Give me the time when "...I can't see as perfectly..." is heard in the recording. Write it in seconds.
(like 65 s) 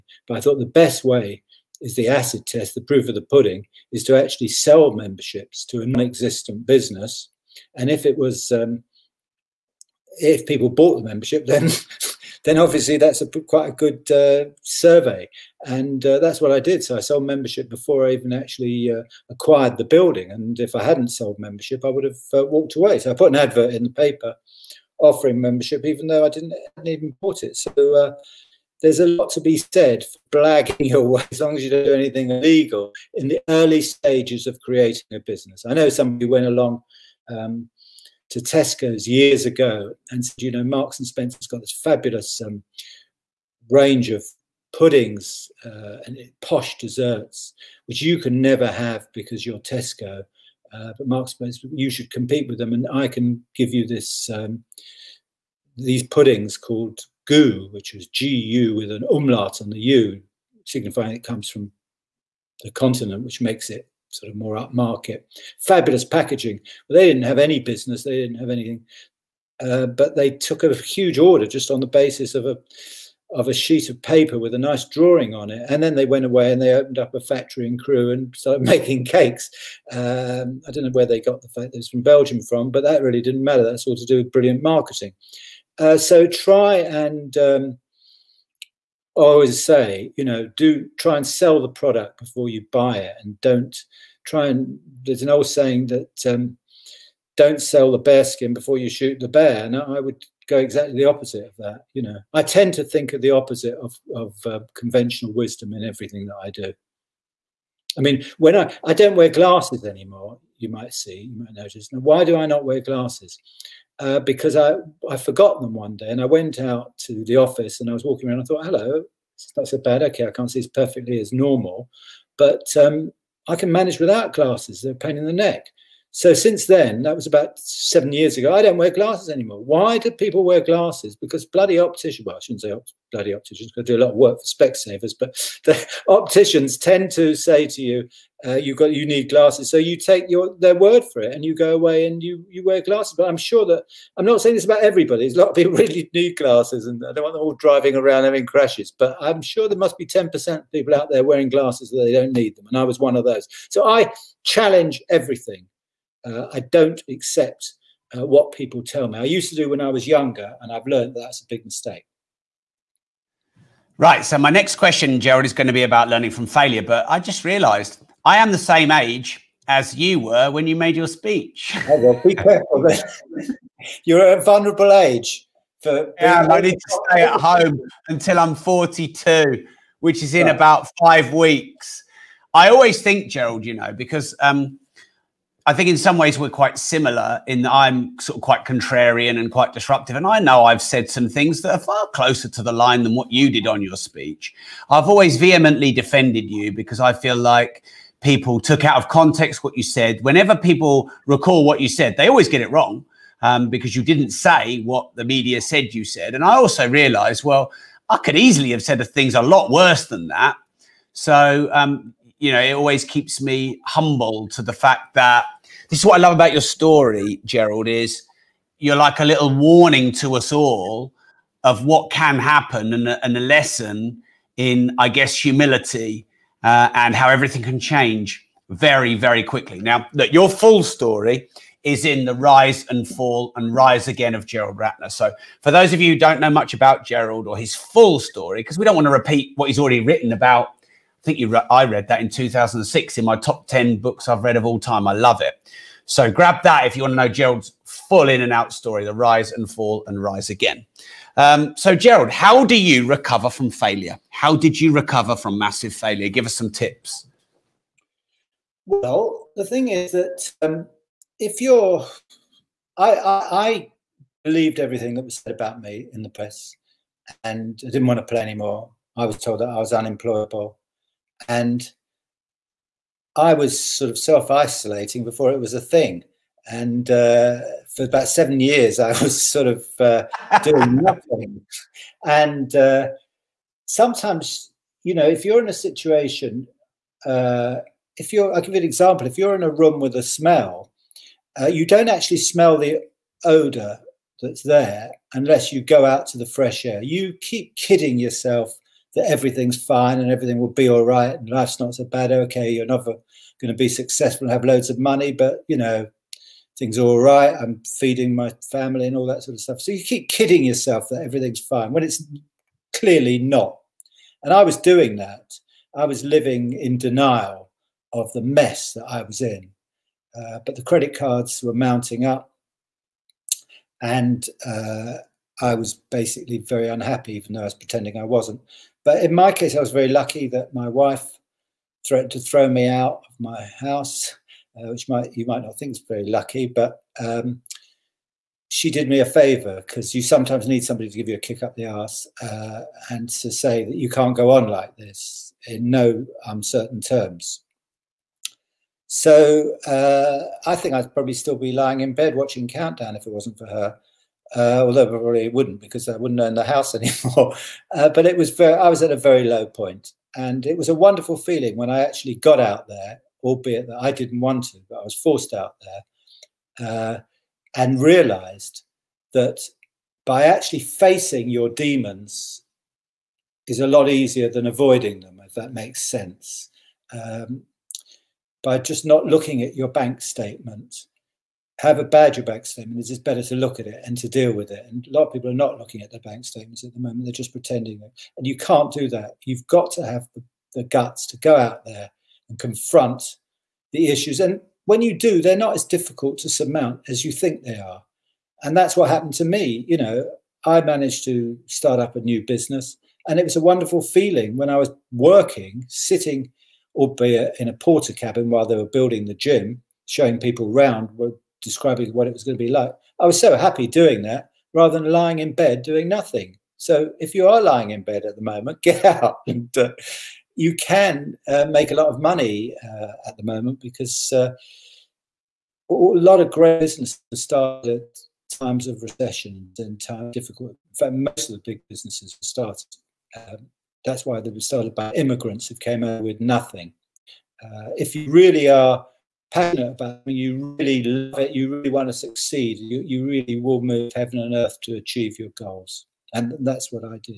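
120 s.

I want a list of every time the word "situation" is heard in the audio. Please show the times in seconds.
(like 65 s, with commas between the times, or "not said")
285 s.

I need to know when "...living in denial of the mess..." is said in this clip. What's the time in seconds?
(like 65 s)
316 s.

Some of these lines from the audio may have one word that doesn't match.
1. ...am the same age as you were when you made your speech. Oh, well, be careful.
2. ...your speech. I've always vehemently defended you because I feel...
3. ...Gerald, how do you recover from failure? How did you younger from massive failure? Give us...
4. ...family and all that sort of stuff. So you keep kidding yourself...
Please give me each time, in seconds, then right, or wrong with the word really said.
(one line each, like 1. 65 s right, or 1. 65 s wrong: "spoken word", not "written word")
1. 168 s right
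2. 193 s right
3. 251 s wrong: "recover", not "younger"
4. 308 s right.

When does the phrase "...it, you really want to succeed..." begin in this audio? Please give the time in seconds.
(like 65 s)
441 s.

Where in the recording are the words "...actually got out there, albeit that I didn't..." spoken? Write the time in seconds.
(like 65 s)
362 s.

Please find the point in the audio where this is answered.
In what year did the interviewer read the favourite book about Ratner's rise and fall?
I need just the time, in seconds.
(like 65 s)
242 s.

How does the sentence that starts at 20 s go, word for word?
And if I hadn't sold membership, I would have uh, walked away.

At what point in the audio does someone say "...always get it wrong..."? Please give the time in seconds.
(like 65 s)
202 s.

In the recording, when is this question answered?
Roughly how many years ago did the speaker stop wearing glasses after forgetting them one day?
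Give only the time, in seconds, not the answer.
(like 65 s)
127 s.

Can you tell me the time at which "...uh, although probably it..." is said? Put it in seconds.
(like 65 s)
354 s.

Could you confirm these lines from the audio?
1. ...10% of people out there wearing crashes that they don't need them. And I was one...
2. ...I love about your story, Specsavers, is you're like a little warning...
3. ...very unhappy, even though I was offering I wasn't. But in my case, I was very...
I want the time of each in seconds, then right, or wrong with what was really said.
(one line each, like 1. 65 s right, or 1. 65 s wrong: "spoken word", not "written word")
1. 150 s wrong: "glasses", not "crashes"
2. 216 s wrong: "Gerald", not "Specsavers"
3. 326 s wrong: "pretending", not "offering".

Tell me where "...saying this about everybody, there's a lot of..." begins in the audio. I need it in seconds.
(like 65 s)
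144 s.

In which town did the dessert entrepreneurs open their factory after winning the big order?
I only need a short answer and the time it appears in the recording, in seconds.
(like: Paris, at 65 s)
Crewe, at 77 s.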